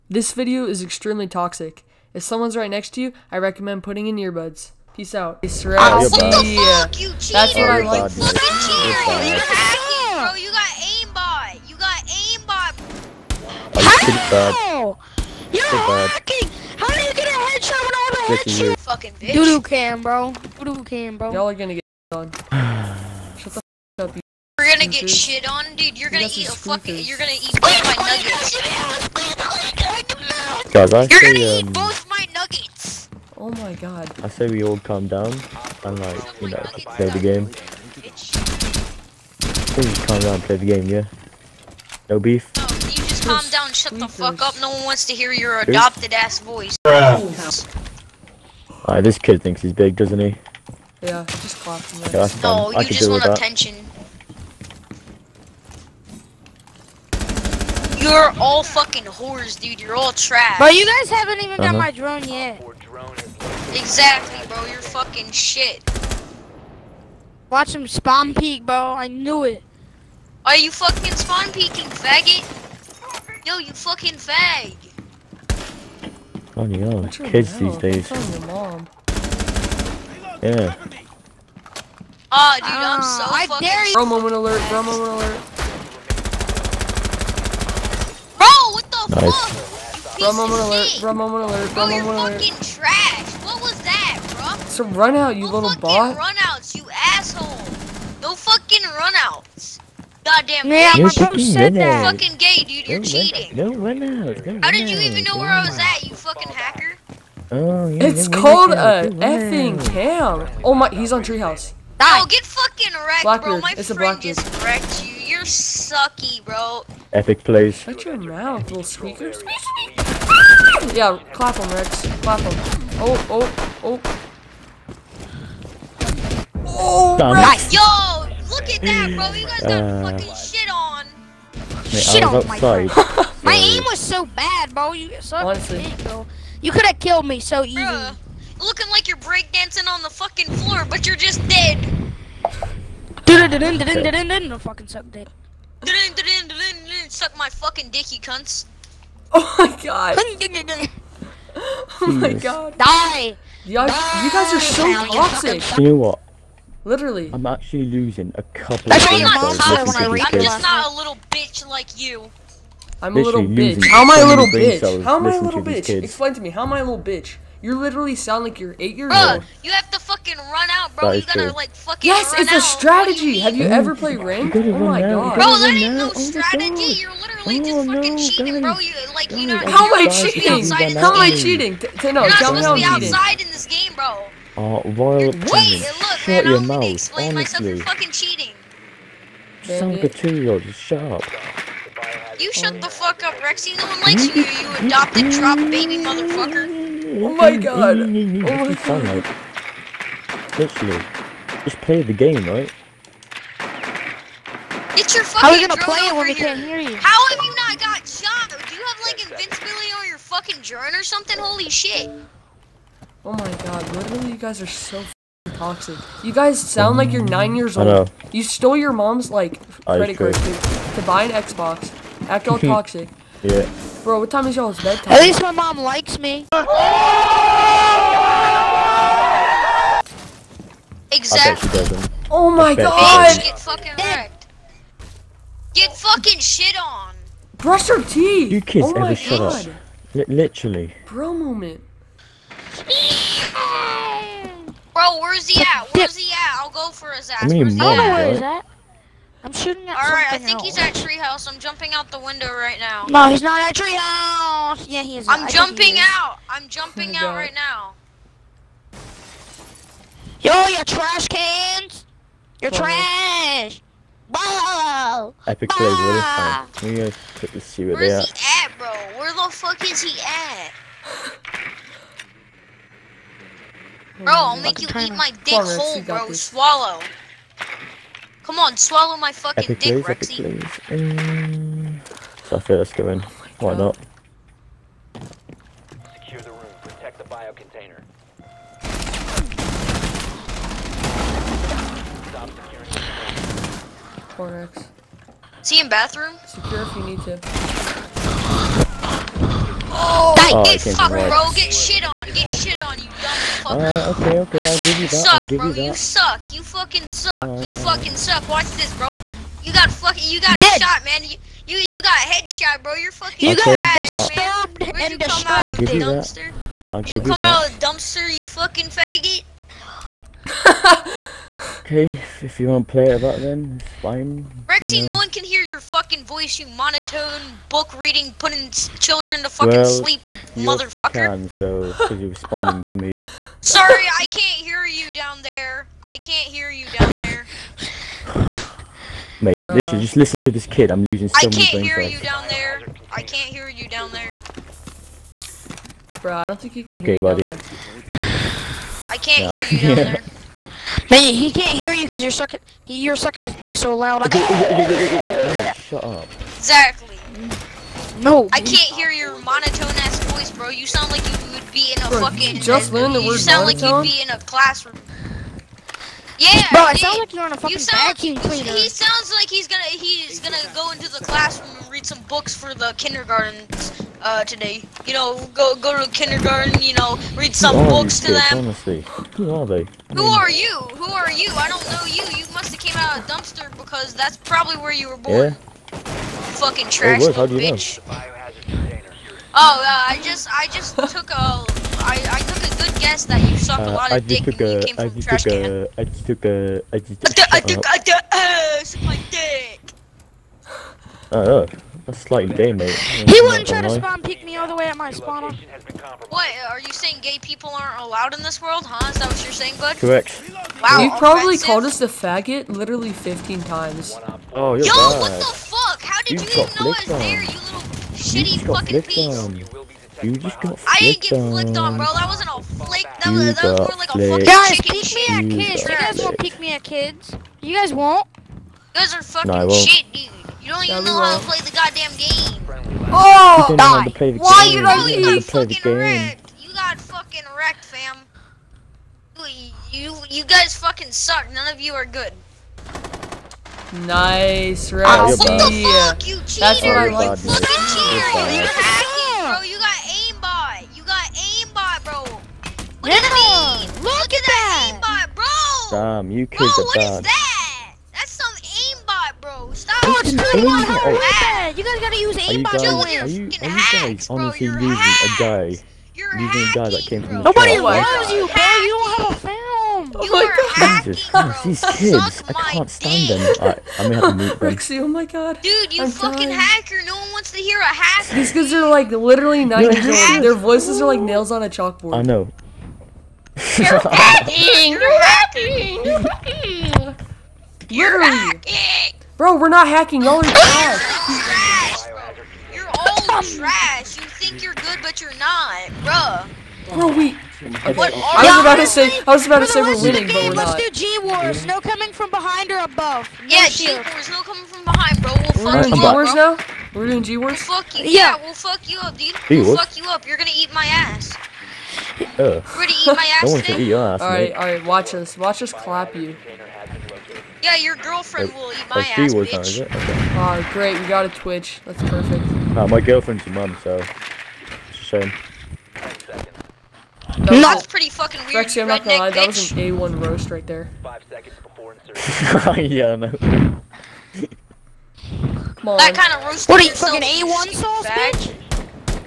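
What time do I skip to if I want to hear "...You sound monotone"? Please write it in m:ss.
6:03.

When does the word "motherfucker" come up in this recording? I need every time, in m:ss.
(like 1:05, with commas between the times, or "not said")
3:15, 5:30.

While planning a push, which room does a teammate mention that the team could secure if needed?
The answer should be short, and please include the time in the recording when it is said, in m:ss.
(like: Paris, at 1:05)
bathroom, at 4:55.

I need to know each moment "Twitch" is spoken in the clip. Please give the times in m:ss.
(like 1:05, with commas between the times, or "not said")
8:41.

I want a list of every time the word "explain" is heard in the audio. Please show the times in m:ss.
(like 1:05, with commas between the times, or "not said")
2:46, 3:06.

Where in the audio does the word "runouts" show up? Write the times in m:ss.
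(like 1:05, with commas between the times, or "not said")
1:38, 1:44.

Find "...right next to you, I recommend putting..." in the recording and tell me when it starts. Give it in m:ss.
0:02.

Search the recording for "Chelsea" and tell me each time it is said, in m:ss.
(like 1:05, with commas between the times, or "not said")
not said.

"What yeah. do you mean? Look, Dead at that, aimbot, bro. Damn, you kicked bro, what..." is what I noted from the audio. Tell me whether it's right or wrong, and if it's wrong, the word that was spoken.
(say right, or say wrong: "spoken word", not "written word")
wrong: "Look", not "Dead".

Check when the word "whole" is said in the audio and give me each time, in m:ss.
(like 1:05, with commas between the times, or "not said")
4:35, 7:40.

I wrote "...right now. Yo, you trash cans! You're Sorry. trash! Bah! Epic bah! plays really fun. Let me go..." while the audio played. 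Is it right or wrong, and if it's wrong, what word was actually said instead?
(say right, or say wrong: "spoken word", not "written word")
right.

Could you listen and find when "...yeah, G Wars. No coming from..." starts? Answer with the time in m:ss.
8:23.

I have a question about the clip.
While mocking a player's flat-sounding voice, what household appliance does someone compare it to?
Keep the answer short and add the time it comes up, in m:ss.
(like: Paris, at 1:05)
vacuum cleaner, at 6:08.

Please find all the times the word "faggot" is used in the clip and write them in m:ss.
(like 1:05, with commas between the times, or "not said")
1:11, 5:18, 6:52.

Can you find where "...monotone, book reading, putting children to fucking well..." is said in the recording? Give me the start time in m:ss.
5:26.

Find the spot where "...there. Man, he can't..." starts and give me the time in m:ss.
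5:50.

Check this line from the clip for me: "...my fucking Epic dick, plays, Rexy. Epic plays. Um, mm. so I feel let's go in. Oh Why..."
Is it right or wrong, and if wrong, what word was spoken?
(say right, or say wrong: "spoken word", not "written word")
right.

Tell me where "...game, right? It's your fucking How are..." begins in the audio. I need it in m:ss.
3:22.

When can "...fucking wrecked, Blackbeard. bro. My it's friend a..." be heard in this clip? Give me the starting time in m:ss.
1:52.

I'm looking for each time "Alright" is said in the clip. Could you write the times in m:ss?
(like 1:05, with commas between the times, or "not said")
0:46, 4:09, 5:03.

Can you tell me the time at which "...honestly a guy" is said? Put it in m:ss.
7:44.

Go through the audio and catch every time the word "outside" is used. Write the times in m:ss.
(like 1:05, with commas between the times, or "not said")
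2:12, 3:02.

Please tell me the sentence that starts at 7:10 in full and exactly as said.
Oh, you don't even know how to play the goddamn game.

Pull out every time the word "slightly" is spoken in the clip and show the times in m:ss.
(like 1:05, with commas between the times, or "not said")
6:42.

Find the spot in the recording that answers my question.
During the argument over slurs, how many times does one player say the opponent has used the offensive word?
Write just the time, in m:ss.
6:53.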